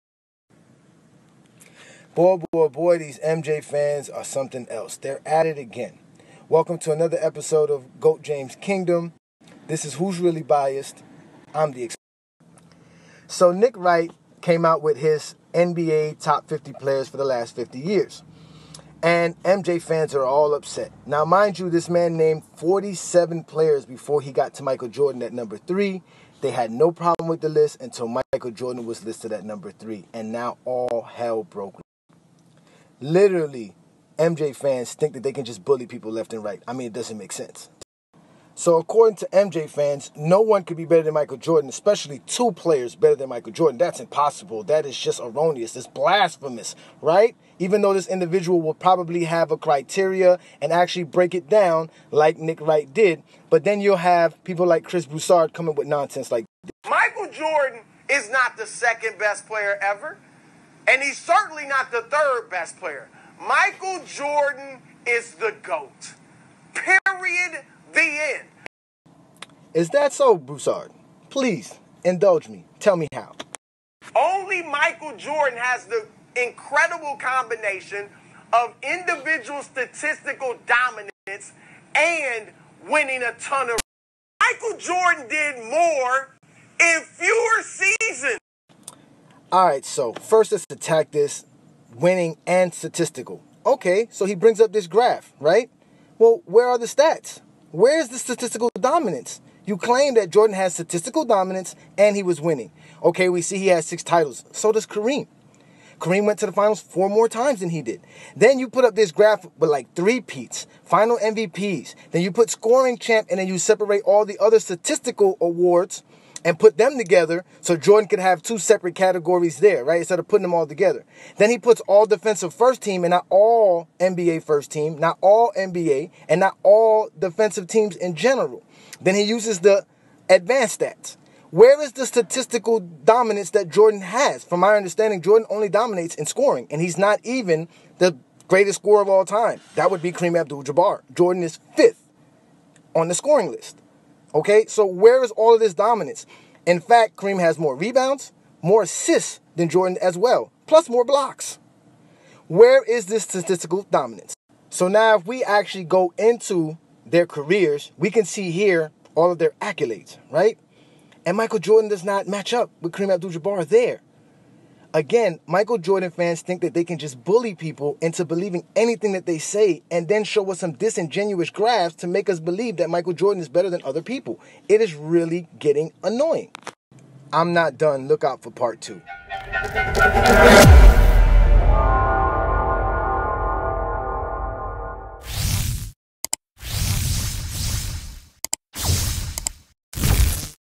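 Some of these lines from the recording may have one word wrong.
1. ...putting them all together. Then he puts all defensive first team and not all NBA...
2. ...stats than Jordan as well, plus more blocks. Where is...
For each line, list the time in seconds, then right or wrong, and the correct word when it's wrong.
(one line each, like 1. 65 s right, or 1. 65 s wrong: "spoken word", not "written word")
1. 120 s right
2. 148 s wrong: "assists", not "stats".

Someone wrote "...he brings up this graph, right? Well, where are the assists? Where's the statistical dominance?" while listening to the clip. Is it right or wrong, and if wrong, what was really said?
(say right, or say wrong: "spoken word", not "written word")
wrong: "stats", not "assists".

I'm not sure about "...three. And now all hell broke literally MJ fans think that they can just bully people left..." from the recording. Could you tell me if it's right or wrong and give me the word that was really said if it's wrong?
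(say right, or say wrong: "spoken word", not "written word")
right.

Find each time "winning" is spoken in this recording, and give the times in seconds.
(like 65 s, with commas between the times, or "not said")
82 s, 91 s, 102 s.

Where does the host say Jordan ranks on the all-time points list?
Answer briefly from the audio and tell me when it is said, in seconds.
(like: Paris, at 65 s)
Fifth, at 141 s.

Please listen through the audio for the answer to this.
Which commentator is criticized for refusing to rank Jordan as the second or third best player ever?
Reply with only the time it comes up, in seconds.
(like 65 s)
54 s.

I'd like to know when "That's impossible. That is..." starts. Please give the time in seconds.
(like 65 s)
43 s.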